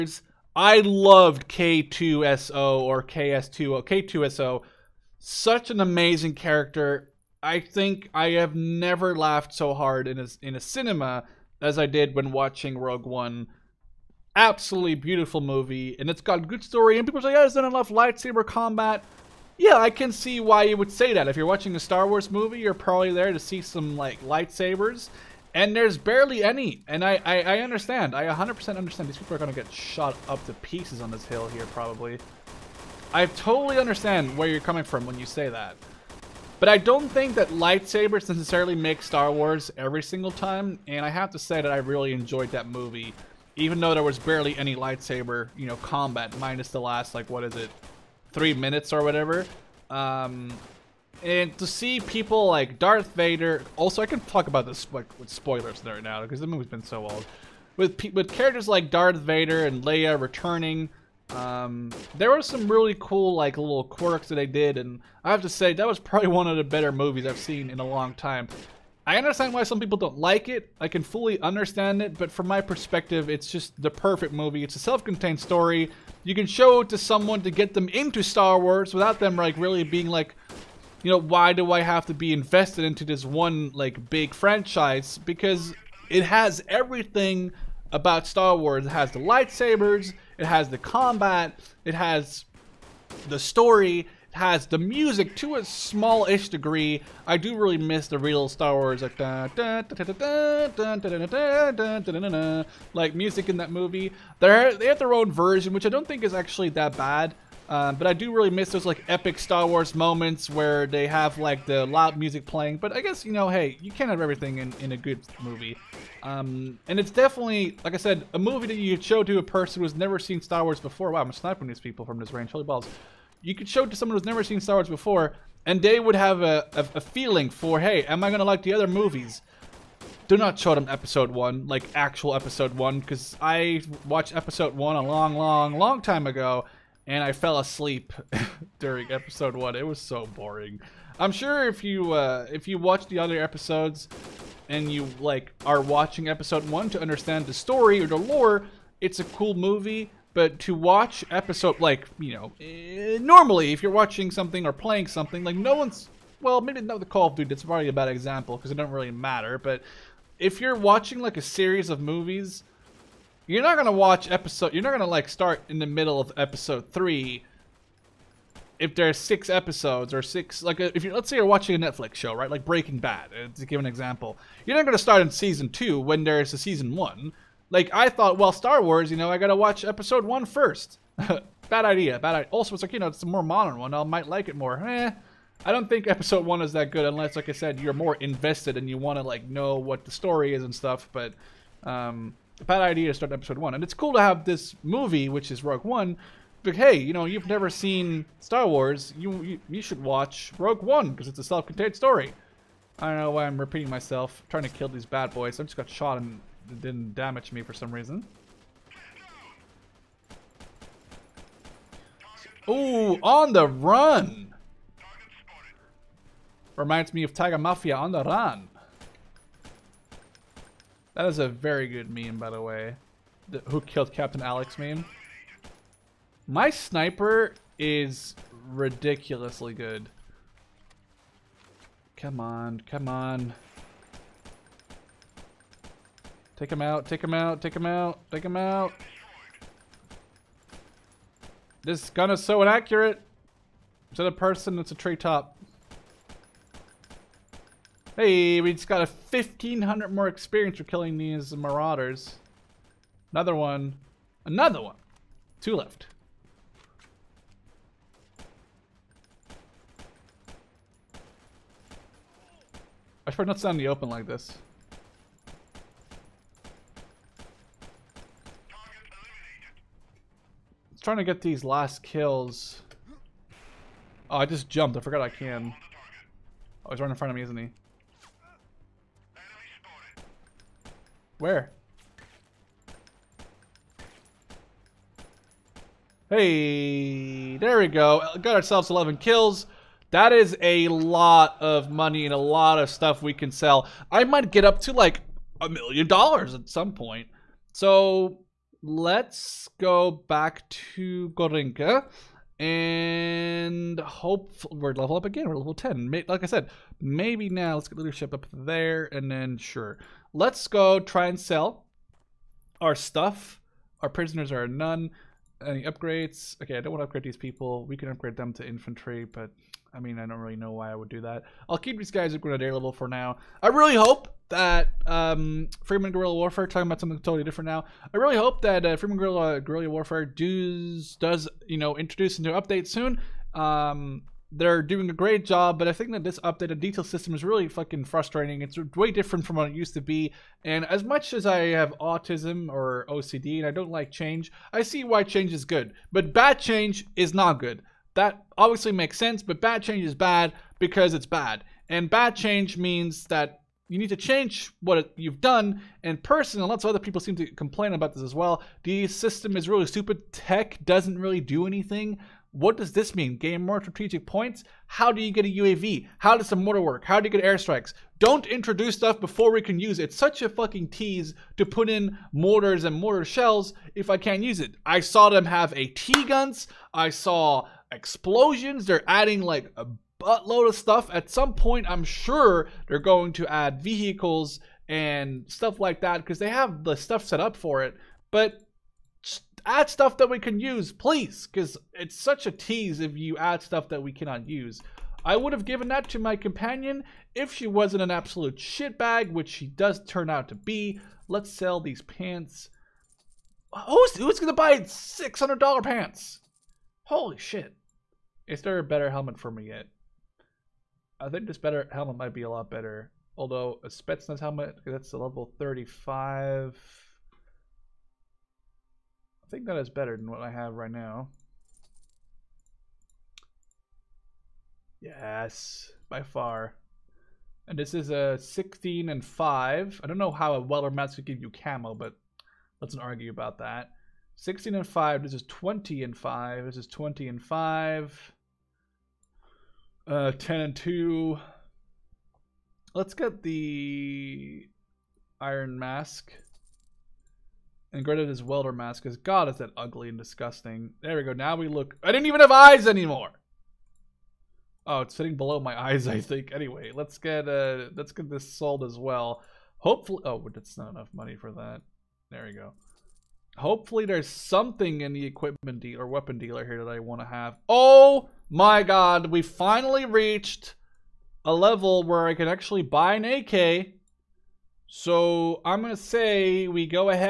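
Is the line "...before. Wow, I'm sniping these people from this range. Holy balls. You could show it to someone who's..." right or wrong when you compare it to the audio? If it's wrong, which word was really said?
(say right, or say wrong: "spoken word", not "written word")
right.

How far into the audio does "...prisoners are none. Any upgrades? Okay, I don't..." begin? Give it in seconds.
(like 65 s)
314 s.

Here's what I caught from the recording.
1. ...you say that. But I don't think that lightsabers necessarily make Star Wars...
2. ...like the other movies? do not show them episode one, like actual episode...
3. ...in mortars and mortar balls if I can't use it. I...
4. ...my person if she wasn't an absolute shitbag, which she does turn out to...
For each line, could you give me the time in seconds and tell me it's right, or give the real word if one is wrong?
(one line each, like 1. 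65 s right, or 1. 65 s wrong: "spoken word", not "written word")
1. 35 s right
2. 128 s right
3. 371 s wrong: "shells", not "balls"
4. 396 s wrong: "companion", not "person".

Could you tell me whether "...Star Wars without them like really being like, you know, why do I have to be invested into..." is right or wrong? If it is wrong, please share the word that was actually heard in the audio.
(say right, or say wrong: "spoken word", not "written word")
right.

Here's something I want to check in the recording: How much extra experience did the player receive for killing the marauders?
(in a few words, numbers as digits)
1,500.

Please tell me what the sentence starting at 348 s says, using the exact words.
That obviously makes sense, but bad change is bad because it's bad.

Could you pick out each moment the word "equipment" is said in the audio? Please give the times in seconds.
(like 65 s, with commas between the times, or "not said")
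465 s.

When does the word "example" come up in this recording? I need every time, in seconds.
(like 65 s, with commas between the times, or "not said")
158 s, 173 s.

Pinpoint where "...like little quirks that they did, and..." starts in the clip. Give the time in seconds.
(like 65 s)
63 s.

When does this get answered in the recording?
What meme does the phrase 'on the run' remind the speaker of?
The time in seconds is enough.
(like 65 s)
217 s.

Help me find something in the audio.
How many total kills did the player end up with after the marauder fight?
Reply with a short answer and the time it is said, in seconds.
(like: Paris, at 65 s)
11, at 288 s.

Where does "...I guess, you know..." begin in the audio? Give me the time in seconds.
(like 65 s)
112 s.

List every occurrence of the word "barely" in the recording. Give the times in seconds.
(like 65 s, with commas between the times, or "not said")
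25 s, 44 s.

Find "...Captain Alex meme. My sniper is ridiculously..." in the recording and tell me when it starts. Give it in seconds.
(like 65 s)
224 s.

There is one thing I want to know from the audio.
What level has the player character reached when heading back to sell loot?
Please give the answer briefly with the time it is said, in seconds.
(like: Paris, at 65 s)
10, at 305 s.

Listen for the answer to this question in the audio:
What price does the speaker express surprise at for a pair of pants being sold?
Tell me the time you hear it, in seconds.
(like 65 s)
404 s.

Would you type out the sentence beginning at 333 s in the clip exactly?
Um, they're doing a great job, but I think that this updated detail system is really fucking frustrating.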